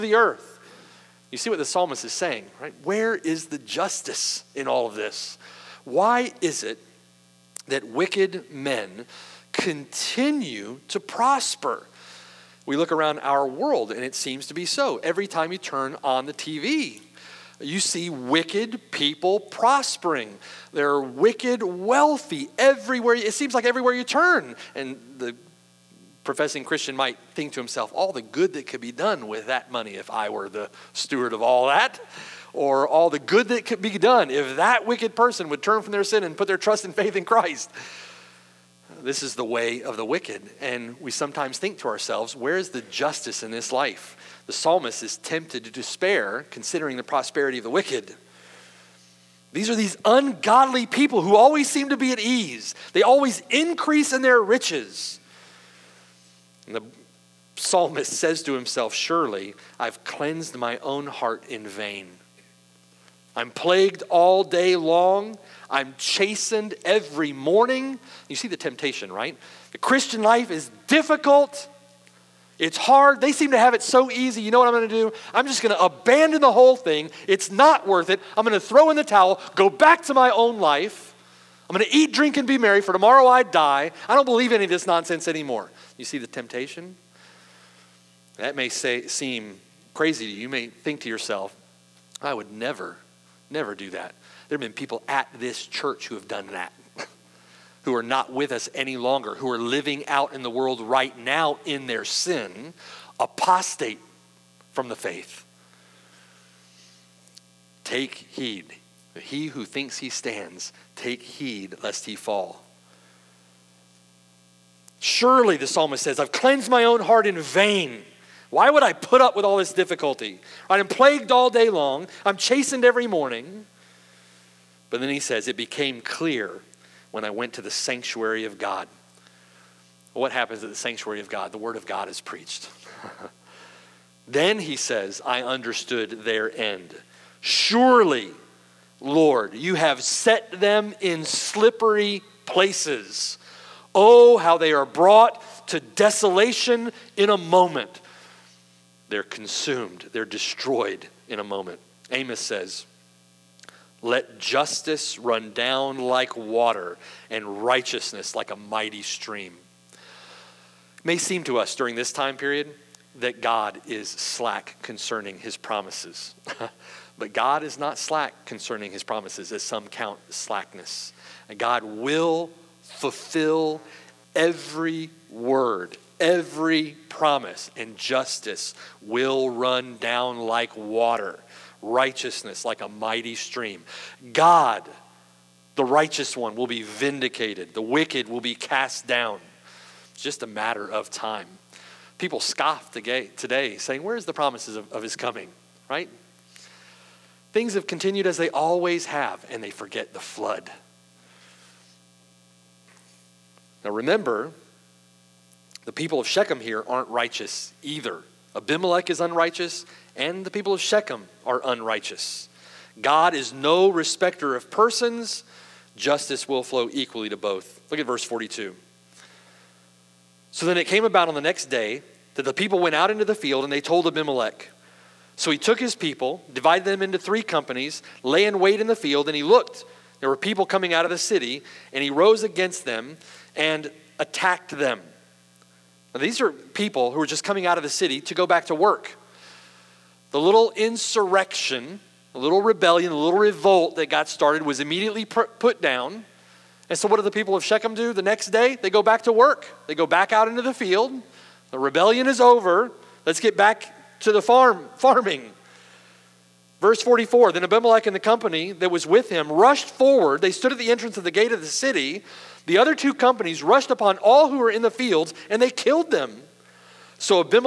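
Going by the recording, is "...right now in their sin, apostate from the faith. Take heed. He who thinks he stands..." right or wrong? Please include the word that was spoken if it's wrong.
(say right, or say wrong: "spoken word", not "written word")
right.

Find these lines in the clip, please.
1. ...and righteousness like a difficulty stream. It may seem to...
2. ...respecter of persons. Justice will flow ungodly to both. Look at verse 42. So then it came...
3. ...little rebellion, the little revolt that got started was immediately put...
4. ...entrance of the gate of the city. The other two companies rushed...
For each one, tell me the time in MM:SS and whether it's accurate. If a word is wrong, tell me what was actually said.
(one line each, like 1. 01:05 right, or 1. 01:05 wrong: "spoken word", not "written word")
1. 02:37 wrong: "mighty", not "difficulty"
2. 03:33 wrong: "equally", not "ungodly"
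3. 04:02 right
4. 04:20 right.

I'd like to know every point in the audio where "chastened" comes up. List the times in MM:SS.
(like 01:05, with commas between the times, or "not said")
01:05, 02:02.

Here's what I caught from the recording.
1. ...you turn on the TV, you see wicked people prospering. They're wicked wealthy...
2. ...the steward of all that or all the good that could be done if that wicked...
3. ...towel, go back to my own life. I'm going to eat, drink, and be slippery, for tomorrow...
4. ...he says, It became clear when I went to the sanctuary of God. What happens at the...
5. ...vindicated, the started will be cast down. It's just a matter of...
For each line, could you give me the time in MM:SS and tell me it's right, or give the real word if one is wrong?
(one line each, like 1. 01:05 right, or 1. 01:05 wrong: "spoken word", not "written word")
1. 00:15 right
2. 00:30 right
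3. 01:19 wrong: "merry", not "slippery"
4. 02:05 right
5. 03:06 wrong: "wicked", not "started".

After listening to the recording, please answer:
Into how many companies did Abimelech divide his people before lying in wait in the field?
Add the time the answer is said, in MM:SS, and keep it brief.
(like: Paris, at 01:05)
3, at 03:47.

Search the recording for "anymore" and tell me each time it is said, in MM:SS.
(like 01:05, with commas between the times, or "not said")
01:25.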